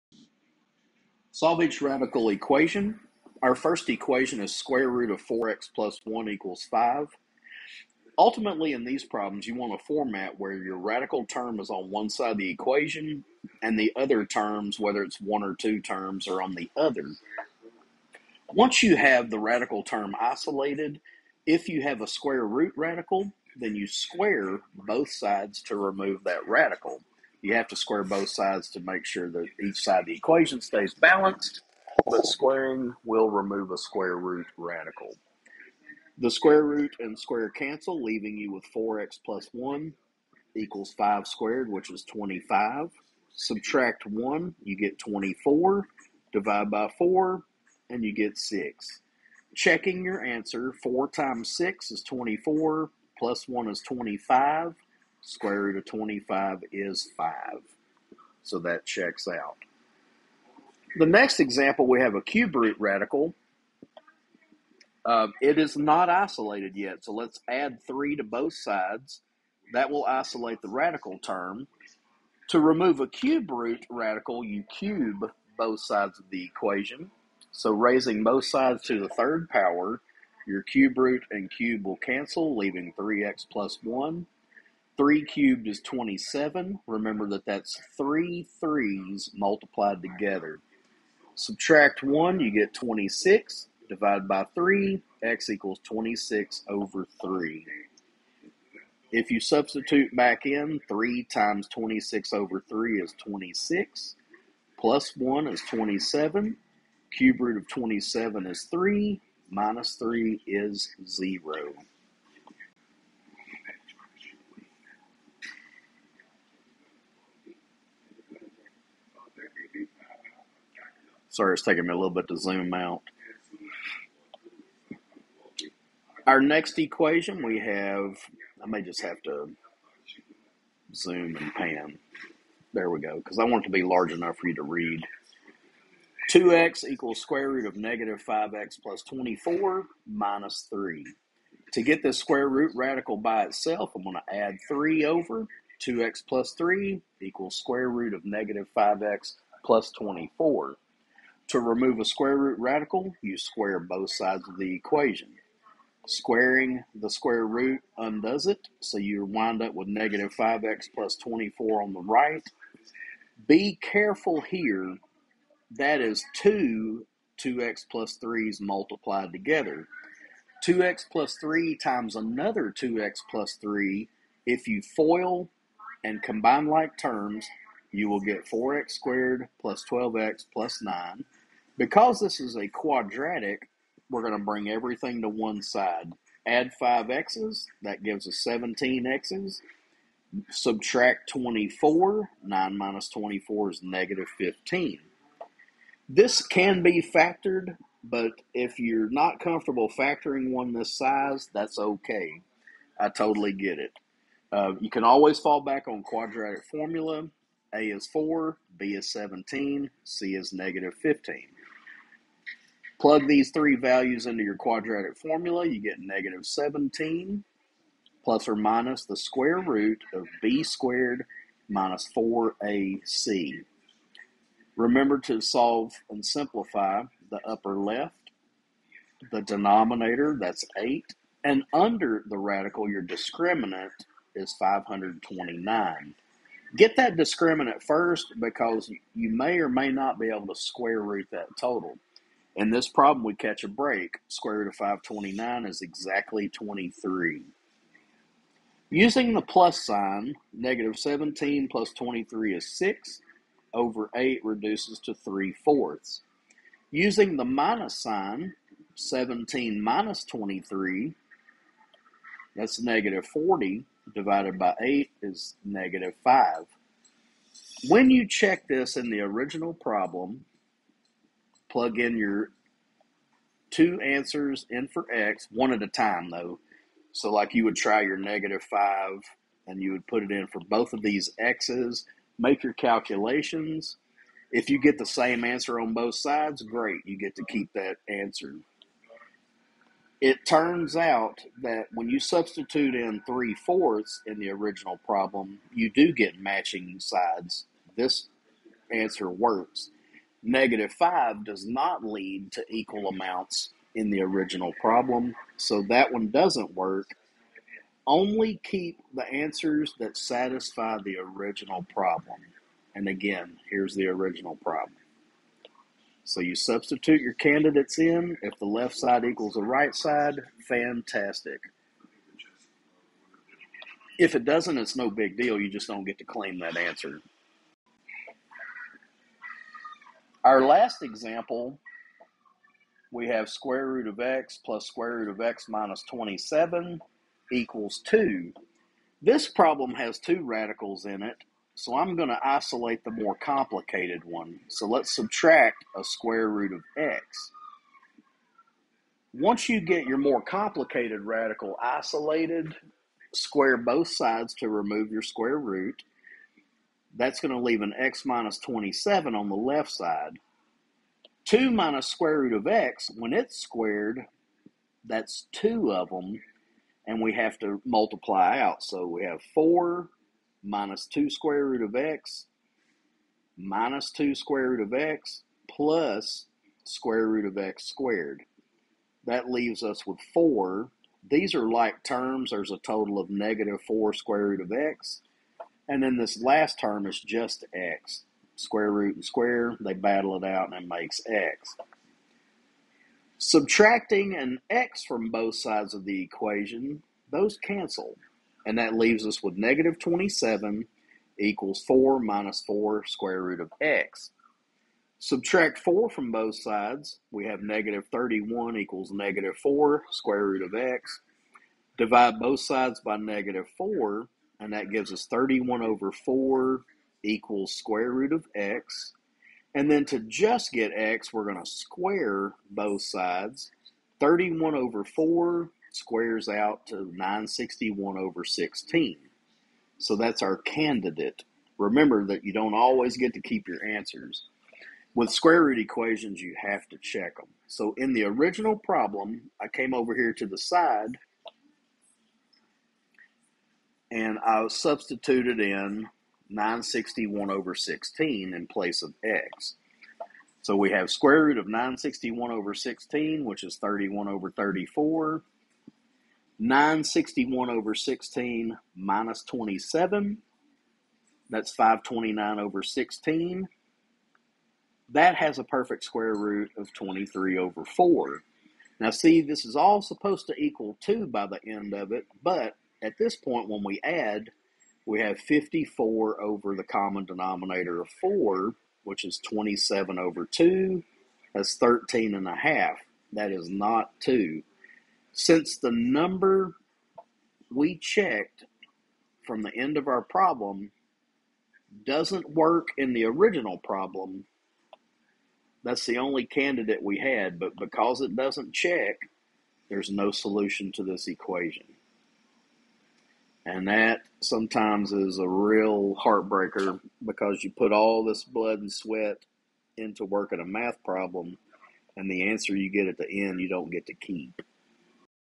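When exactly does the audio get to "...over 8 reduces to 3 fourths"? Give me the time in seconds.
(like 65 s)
253 s.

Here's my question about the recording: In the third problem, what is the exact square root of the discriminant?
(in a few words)
23.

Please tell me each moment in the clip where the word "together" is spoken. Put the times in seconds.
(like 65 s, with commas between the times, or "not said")
89 s, 169 s.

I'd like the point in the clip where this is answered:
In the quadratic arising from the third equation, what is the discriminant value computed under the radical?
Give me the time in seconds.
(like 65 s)
232 s.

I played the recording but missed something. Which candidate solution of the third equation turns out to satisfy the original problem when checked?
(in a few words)
3/4.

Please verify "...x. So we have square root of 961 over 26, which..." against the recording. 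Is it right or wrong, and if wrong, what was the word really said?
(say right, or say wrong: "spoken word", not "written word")
wrong: "16", not "26".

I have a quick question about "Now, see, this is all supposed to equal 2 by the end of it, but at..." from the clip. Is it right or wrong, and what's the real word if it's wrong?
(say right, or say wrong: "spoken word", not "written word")
right.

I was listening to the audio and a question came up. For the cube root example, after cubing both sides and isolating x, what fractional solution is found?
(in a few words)
26/3.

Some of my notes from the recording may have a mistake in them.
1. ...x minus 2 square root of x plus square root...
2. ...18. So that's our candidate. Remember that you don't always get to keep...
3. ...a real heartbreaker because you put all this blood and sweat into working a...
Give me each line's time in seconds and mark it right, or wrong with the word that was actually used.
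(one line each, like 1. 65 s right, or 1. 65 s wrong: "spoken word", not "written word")
1. 371 s right
2. 428 s wrong: "16", not "18"
3. 505 s right.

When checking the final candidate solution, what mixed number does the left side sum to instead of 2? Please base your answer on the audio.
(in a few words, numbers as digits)
13 and a half.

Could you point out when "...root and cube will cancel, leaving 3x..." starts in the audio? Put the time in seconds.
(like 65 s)
80 s.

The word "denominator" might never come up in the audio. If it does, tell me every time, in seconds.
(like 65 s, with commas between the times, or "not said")
229 s, 477 s.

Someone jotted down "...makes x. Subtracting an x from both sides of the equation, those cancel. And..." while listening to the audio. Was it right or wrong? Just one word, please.
right.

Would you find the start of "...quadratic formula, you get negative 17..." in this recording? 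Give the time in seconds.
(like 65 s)
214 s.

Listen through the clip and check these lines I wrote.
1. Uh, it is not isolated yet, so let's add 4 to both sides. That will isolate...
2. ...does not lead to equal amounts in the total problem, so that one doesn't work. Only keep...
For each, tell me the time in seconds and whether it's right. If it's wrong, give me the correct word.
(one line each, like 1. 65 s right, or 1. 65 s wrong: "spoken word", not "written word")
1. 65 s wrong: "3", not "4"
2. 301 s wrong: "original", not "total".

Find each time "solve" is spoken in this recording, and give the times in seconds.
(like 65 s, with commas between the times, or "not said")
1 s, 225 s.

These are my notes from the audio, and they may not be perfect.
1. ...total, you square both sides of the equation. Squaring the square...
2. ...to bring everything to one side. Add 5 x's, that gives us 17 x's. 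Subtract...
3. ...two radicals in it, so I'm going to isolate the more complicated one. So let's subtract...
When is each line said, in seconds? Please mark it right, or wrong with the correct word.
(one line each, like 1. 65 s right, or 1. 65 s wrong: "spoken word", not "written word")
1. 152 s wrong: "radical", not "total"
2. 184 s right
3. 340 s right.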